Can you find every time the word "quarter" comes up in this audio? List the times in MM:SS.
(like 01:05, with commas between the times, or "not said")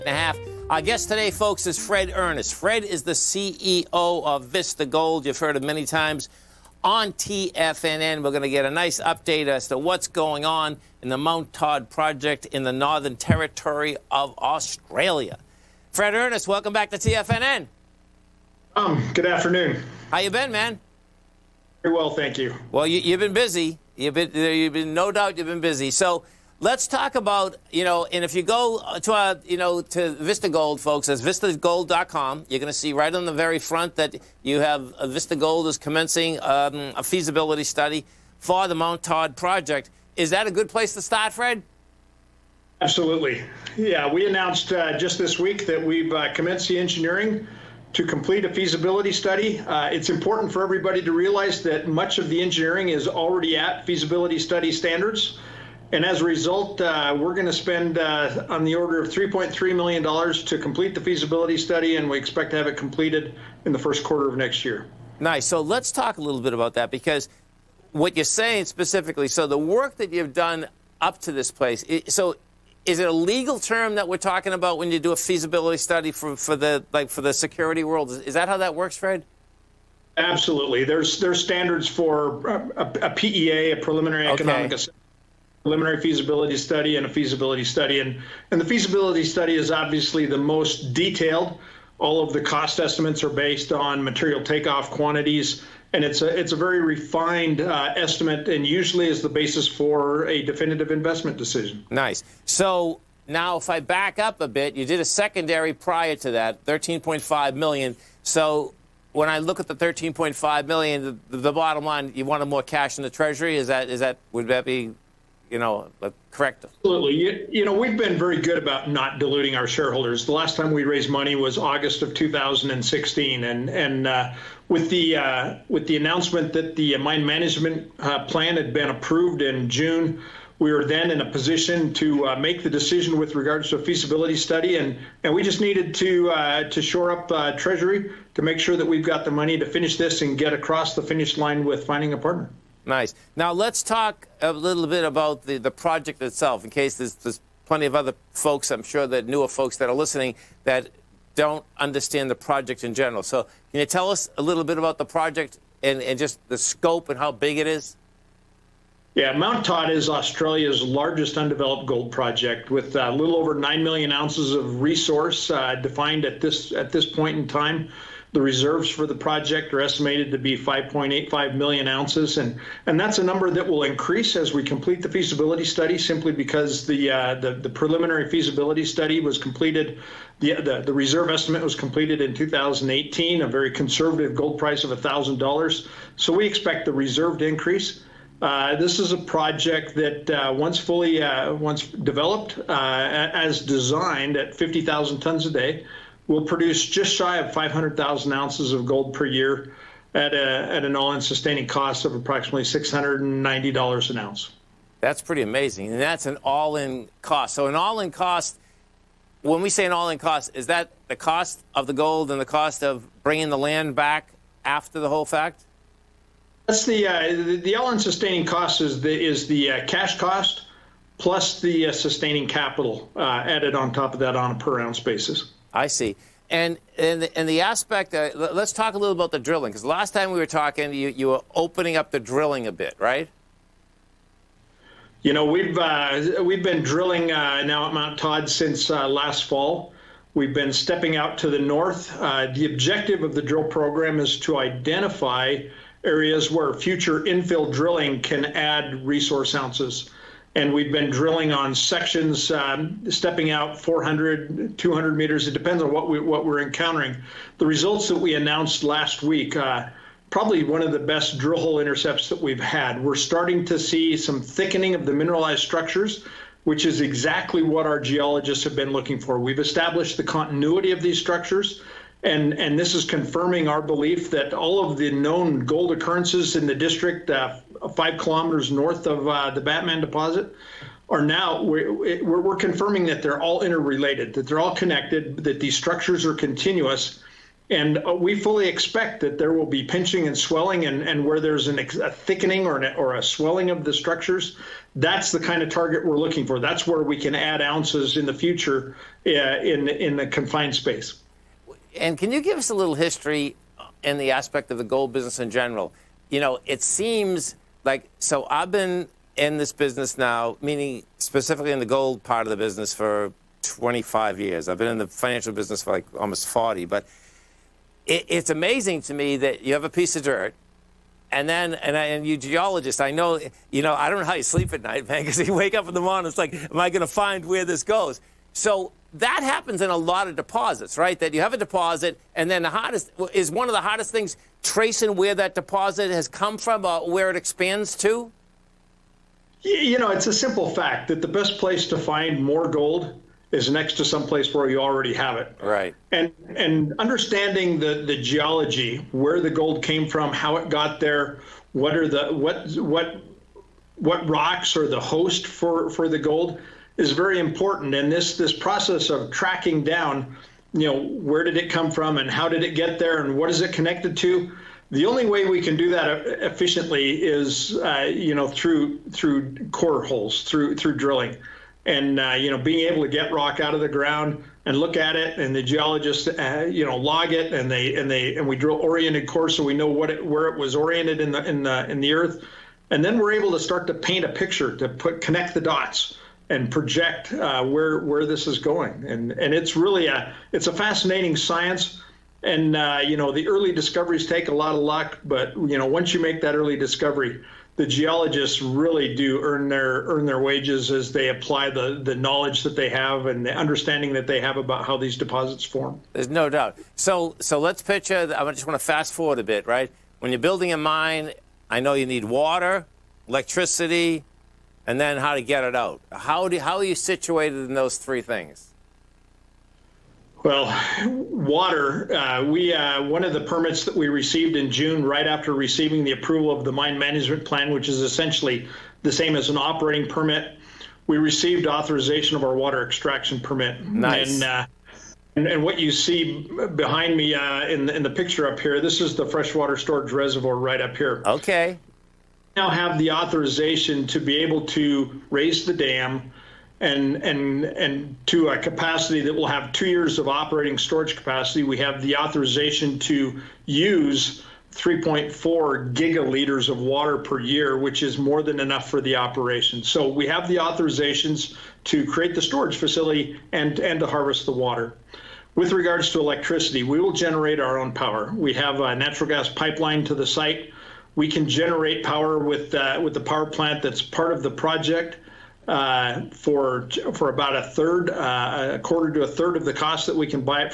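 01:04, 07:58.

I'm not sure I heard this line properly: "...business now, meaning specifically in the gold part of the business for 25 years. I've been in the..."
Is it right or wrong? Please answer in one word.
right.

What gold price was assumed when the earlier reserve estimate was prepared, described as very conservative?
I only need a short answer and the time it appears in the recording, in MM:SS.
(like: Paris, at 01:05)
$1,000, at 03:05.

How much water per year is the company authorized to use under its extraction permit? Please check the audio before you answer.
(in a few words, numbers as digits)
3.4 gigaliters.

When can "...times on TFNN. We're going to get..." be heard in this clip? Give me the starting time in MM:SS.
00:05.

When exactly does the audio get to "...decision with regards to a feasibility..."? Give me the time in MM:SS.
02:12.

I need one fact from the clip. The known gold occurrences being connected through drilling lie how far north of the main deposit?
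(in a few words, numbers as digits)
5 kilometers.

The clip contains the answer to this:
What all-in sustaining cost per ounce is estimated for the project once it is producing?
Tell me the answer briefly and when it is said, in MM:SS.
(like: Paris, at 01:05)
$690, at 03:22.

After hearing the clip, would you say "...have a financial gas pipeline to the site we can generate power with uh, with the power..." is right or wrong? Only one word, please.
wrong.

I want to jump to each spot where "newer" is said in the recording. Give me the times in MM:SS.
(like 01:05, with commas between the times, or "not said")
02:29.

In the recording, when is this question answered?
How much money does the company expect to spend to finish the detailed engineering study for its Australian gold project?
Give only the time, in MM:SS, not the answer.
00:59.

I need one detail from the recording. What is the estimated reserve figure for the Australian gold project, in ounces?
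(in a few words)
5.85 million ounces.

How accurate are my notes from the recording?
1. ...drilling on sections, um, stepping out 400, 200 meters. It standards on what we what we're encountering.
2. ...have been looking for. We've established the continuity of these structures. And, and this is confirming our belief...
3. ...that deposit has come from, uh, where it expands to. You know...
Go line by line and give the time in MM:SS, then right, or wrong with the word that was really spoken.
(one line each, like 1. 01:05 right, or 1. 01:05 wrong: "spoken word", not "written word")
1. 04:11 wrong: "depends", not "standards"
2. 04:28 right
3. 05:35 right.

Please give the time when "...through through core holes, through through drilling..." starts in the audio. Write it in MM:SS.
06:08.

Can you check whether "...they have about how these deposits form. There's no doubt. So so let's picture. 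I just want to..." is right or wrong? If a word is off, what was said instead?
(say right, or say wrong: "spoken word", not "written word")
right.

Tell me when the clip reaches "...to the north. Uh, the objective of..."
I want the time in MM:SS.
04:01.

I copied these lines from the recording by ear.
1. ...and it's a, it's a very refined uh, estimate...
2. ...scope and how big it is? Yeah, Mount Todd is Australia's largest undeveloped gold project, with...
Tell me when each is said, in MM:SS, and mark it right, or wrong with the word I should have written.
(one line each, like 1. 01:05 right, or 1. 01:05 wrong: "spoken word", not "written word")
1. 01:35 right
2. 02:36 right.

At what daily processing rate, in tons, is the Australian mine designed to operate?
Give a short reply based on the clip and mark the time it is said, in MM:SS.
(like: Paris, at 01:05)
50,000 tons, at 03:14.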